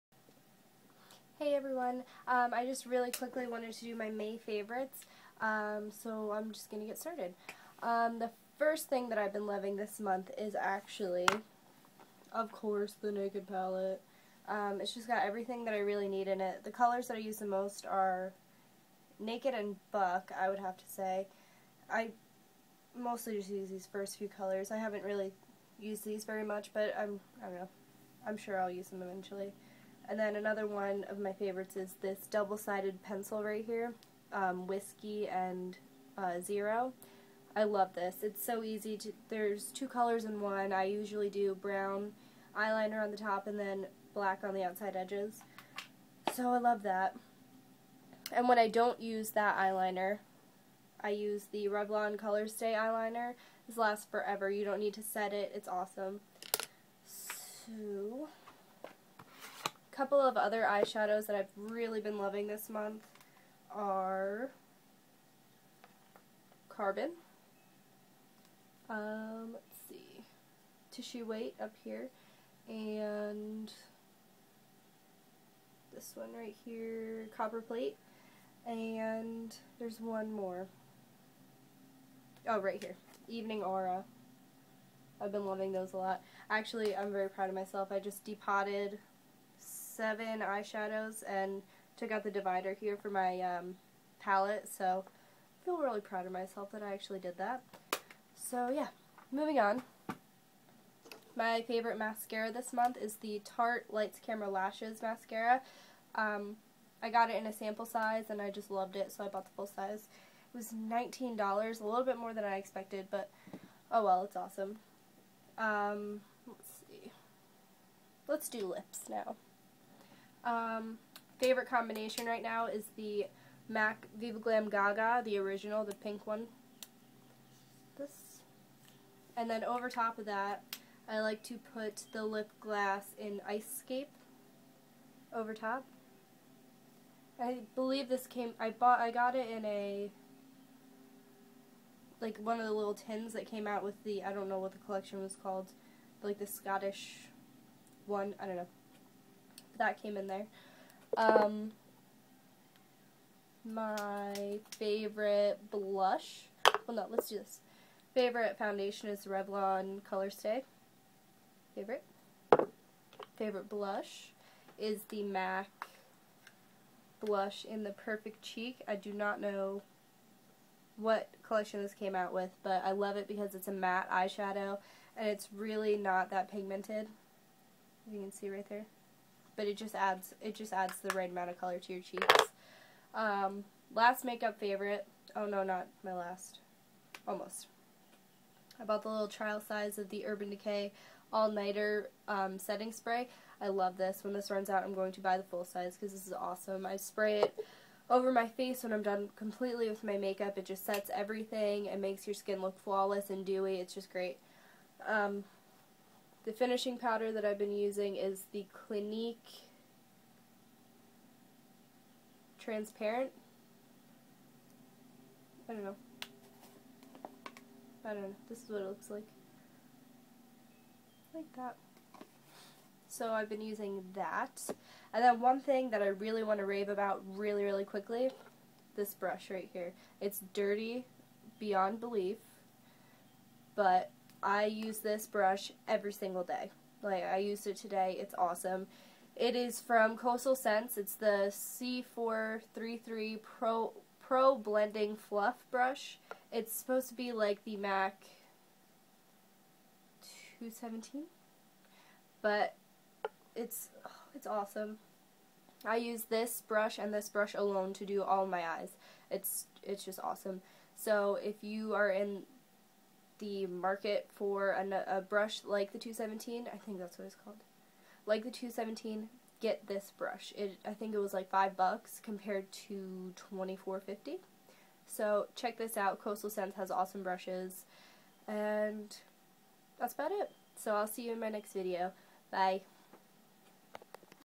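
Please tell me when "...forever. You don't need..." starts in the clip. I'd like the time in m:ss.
0:54.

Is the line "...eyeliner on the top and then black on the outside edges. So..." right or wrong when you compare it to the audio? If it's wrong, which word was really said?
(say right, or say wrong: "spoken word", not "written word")
right.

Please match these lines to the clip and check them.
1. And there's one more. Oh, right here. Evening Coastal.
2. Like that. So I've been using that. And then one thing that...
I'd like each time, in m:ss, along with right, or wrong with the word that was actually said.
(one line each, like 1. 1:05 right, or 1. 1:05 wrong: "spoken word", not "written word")
1. 1:18 wrong: "Aura", not "Coastal"
2. 3:41 right.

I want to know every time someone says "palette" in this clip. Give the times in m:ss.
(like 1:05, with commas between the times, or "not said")
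0:13, 1:34.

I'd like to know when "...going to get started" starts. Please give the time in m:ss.
0:06.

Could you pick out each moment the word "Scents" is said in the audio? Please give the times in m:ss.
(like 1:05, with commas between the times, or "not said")
4:00, 4:36.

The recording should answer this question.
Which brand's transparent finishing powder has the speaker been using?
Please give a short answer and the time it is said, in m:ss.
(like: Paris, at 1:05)
Clinique, at 3:28.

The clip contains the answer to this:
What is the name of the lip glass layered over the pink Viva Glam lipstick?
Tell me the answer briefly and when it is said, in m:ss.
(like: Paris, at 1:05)
Ice Scape, at 2:13.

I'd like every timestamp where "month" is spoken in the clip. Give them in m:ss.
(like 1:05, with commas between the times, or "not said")
0:09, 1:02, 1:42.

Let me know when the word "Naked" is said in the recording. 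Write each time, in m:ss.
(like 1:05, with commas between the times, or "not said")
0:13, 0:19.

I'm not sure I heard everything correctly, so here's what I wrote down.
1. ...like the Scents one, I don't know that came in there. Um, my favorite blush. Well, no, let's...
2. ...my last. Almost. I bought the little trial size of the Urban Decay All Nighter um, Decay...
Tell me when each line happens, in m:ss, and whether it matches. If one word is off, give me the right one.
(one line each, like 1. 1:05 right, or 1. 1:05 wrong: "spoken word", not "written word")
1. 2:26 wrong: "Scottish", not "Scents"
2. 3:06 wrong: "Setting", not "Decay".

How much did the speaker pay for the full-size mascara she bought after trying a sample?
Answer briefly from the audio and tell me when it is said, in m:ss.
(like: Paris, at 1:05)
$19, at 1:50.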